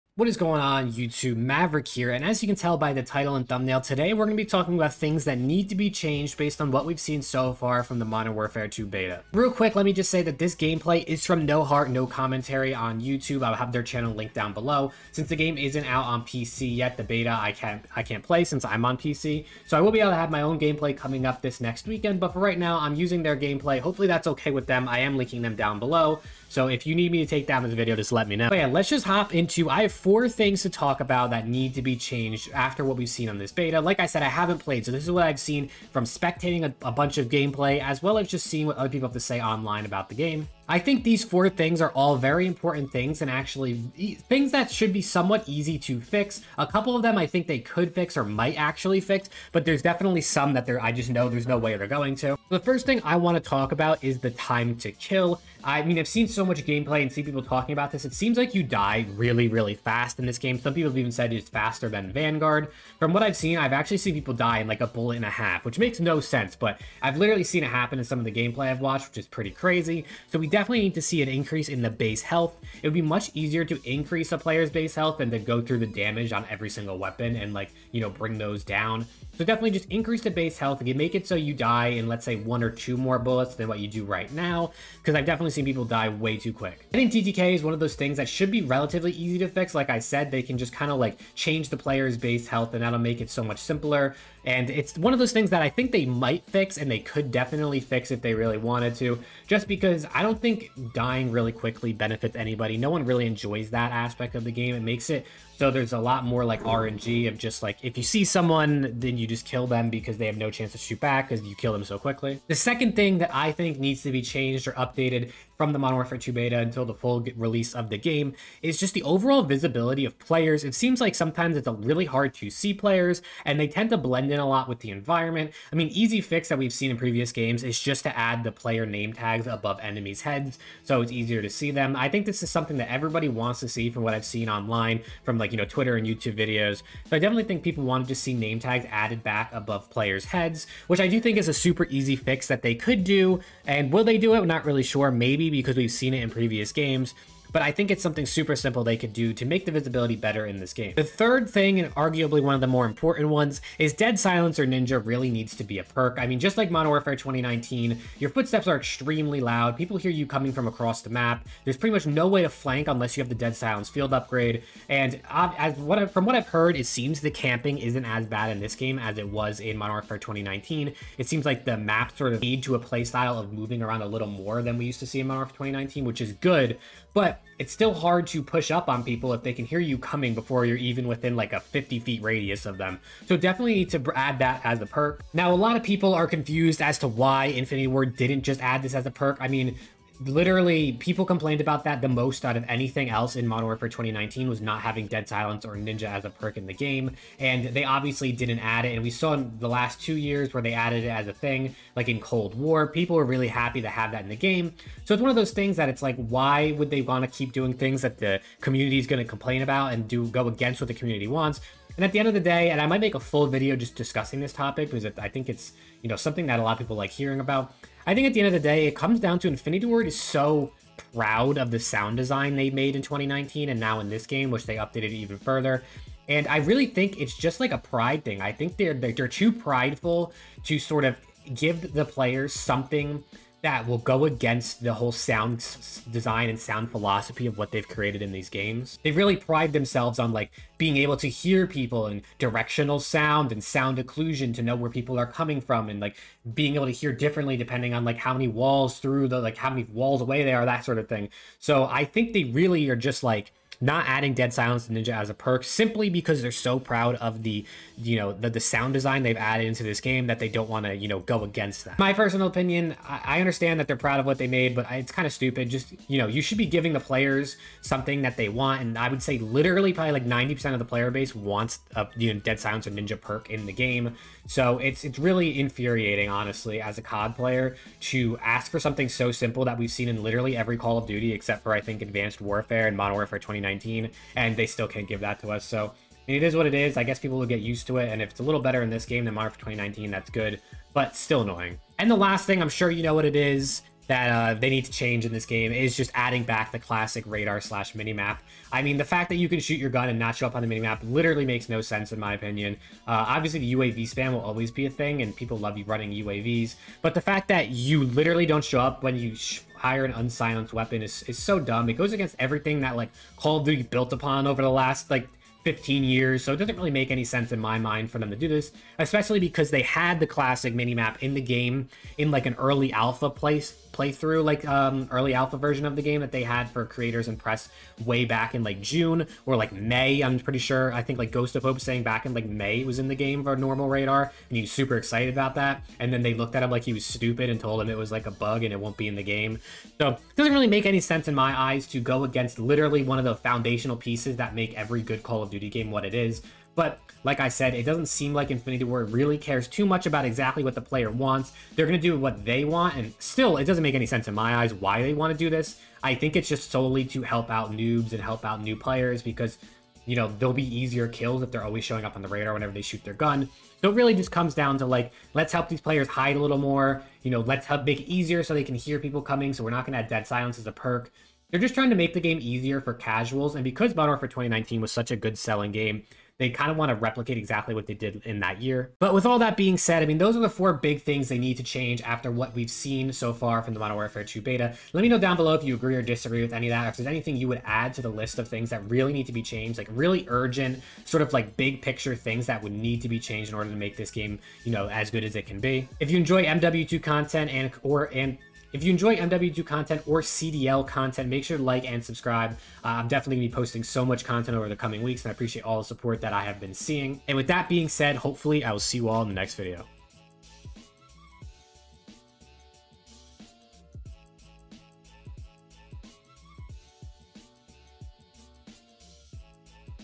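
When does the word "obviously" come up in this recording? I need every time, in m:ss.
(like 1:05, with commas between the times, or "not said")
3:17, 5:03.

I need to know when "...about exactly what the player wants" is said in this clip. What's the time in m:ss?
5:50.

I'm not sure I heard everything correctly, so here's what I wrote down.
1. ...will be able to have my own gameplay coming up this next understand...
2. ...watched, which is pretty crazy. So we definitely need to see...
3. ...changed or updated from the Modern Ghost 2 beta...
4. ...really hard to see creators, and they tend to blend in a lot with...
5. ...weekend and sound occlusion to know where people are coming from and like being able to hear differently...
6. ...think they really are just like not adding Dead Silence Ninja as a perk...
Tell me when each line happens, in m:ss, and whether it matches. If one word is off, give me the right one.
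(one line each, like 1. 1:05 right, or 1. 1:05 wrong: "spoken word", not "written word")
1. 0:19 wrong: "weekend", not "understand"
2. 1:08 right
3. 1:54 wrong: "Warfare", not "Ghost"
4. 2:01 wrong: "players", not "creators"
5. 4:02 wrong: "sound", not "weekend"
6. 4:12 right.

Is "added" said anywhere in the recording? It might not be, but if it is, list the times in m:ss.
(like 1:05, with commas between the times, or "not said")
2:18, 3:20, 4:19.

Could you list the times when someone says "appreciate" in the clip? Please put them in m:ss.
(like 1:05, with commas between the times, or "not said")
6:45.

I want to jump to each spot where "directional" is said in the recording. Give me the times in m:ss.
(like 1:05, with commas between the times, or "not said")
4:02.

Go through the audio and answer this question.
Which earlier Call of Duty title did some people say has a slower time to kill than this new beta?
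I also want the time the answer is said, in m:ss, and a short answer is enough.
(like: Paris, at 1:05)
Vanguard, at 1:02.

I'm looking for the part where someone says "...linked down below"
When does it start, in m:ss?
0:14.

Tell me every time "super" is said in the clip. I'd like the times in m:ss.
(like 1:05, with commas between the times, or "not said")
2:21, 2:28, 5:34.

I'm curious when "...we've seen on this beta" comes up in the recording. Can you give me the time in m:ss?
0:32.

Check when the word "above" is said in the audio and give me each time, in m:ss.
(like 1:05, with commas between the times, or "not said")
2:09, 2:19.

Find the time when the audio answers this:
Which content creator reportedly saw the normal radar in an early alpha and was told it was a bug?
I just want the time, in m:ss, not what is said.
5:31.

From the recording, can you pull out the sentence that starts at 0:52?
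The first thing I want to talk about is the time to kill.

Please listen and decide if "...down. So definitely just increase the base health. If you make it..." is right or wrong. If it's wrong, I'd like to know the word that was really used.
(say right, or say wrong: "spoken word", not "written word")
right.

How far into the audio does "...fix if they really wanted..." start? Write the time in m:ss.
1:37.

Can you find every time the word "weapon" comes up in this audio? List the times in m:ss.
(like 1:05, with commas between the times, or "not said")
1:16, 5:10.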